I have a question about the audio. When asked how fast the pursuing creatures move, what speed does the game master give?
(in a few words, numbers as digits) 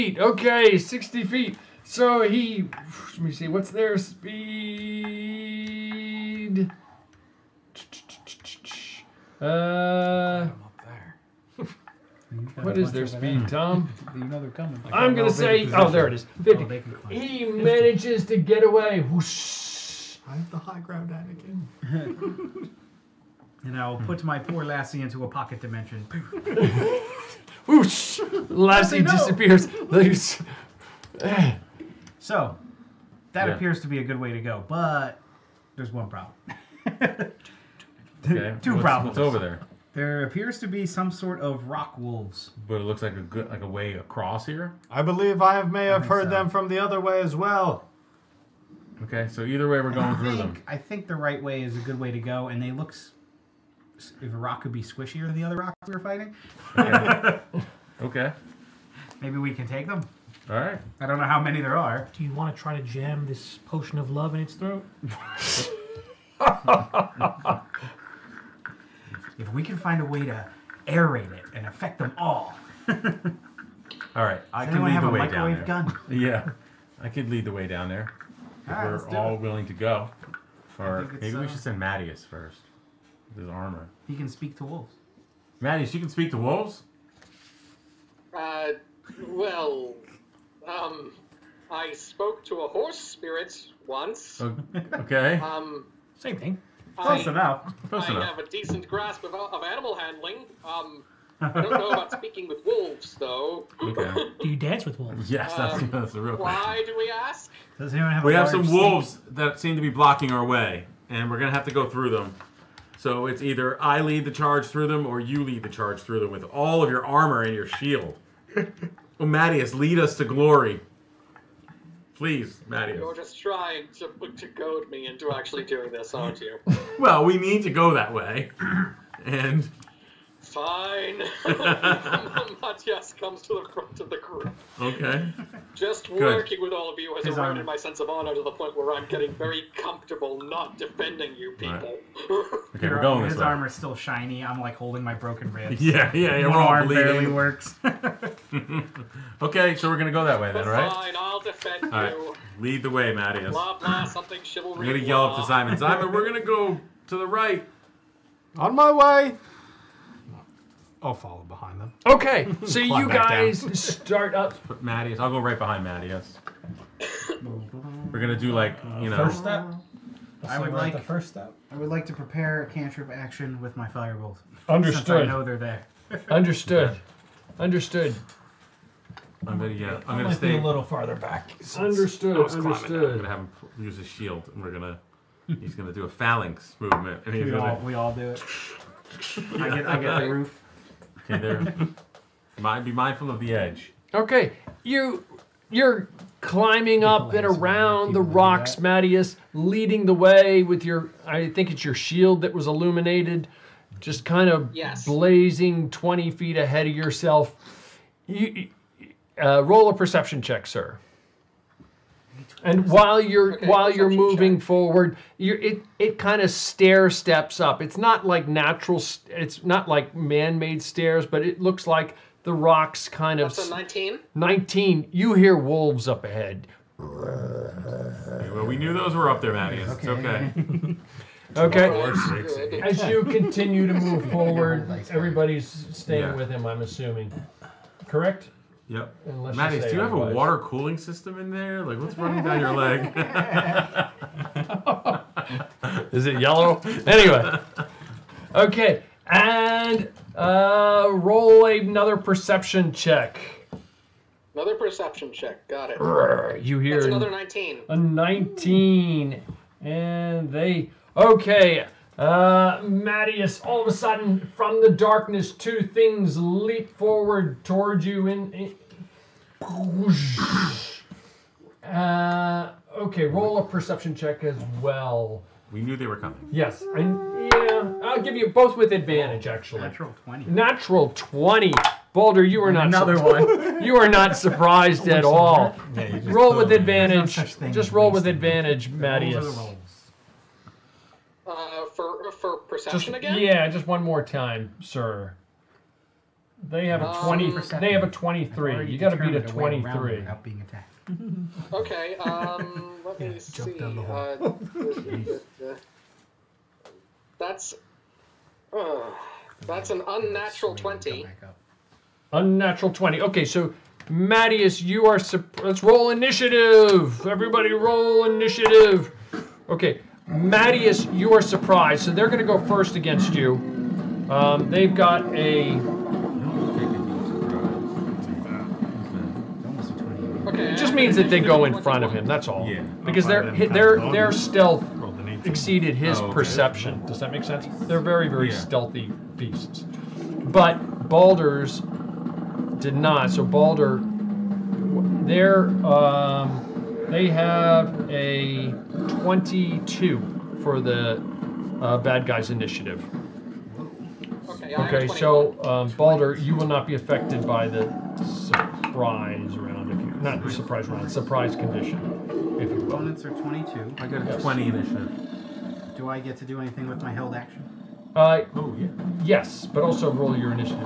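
50.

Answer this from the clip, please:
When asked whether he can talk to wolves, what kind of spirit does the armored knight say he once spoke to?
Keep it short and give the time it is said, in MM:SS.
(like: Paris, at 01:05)
a horse spirit, at 01:32.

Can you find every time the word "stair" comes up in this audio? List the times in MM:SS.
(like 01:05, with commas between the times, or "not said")
03:36, 03:40.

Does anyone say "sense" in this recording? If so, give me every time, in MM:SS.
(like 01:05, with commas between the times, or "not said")
02:17, 05:37.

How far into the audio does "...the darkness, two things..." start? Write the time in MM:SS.
04:24.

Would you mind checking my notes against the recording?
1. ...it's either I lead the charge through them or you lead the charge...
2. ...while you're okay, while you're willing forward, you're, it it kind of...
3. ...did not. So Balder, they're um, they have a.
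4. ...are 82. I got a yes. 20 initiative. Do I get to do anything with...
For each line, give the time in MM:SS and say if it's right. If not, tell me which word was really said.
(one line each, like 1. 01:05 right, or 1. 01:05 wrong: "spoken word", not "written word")
1. 01:53 right
2. 03:32 wrong: "moving", not "willing"
3. 05:42 right
4. 06:03 wrong: "22", not "82".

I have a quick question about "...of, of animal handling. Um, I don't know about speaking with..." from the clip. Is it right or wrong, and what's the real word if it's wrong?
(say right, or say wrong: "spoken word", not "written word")
right.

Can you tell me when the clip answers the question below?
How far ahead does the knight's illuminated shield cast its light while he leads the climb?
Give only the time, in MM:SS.
03:25.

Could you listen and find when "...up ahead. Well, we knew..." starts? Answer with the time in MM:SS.
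03:46.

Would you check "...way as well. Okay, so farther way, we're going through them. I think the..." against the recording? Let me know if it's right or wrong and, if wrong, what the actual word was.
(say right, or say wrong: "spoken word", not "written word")
wrong: "either", not "farther".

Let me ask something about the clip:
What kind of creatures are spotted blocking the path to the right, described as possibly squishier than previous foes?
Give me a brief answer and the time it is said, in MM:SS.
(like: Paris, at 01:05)
rock wolves, at 00:41.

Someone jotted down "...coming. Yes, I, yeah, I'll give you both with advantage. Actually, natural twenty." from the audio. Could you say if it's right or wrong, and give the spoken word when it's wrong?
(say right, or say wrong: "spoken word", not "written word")
right.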